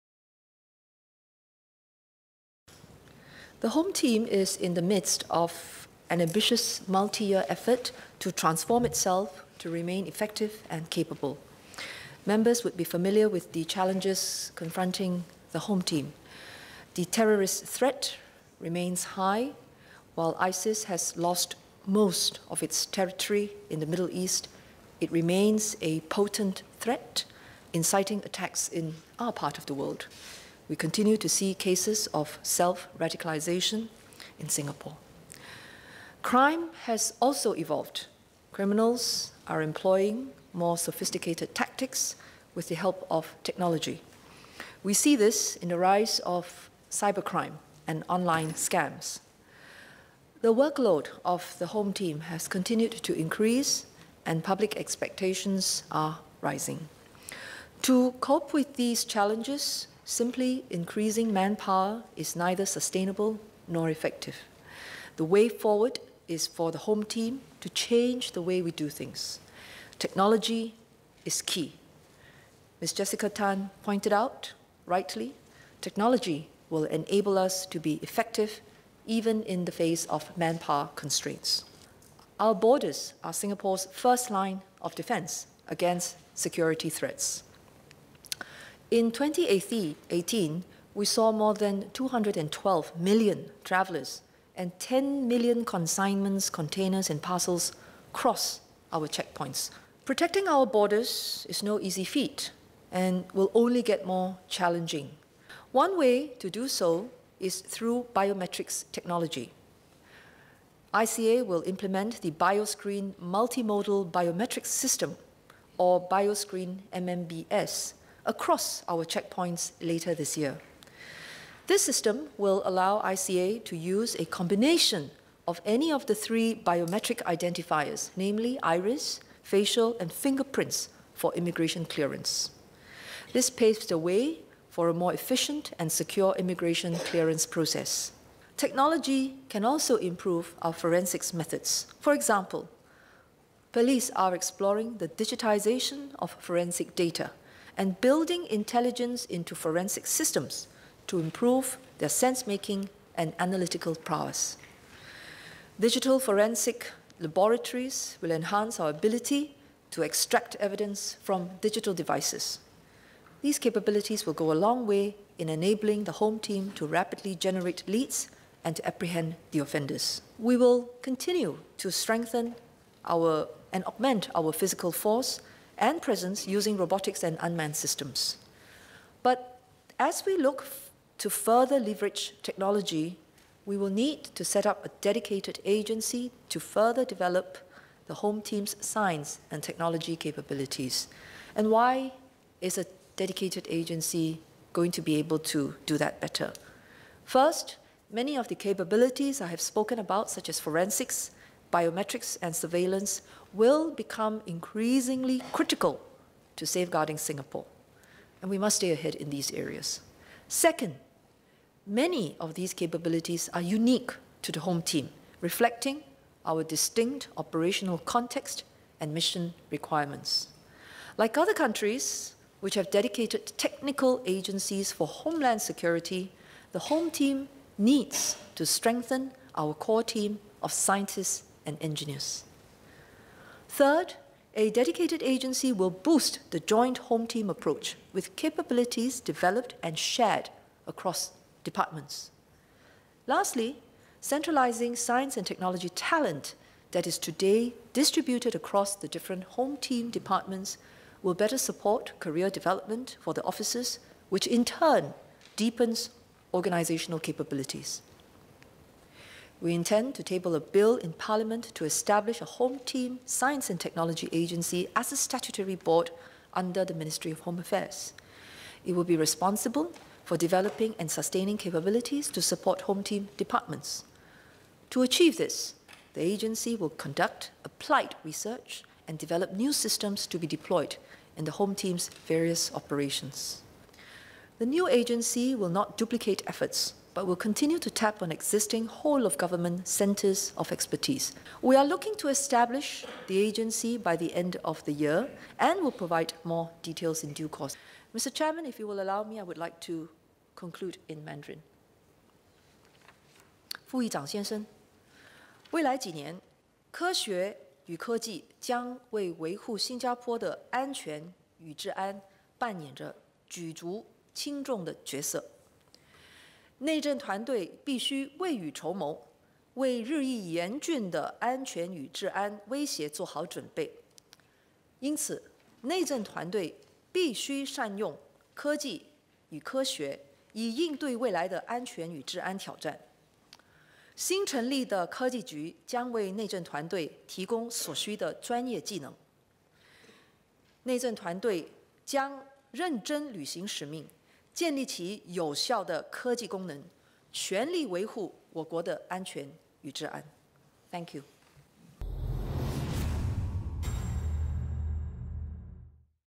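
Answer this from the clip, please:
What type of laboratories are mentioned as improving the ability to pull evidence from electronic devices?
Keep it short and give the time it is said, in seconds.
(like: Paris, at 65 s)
Digital forensic laboratories, at 155 s.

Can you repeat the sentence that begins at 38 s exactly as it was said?
Criminals are employing more sophisticated tactics with the help of technology.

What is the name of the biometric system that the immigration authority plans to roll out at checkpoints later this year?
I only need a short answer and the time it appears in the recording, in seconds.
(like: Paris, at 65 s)
Bioscreen MMBS, at 116 s.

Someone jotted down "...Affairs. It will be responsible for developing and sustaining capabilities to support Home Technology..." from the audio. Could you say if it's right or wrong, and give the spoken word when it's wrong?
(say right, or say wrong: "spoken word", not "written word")
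wrong: "Team", not "Technology".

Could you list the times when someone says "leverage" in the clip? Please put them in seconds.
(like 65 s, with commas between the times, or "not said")
181 s.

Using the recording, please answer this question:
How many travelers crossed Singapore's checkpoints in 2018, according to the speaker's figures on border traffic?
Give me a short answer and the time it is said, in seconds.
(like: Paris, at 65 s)
212 million, at 91 s.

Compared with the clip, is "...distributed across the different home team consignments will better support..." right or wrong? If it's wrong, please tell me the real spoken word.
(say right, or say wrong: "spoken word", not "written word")
wrong: "departments", not "consignments".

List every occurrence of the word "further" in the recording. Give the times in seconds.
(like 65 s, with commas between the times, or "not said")
181 s, 186 s.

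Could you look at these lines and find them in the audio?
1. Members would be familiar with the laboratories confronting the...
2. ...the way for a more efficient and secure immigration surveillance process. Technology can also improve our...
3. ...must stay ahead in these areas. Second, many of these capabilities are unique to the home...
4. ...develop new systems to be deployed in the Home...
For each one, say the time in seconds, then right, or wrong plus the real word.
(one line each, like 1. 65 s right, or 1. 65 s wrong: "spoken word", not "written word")
1. 12 s wrong: "challenges", not "laboratories"
2. 133 s wrong: "clearance", not "surveillance"
3. 208 s right
4. 279 s right.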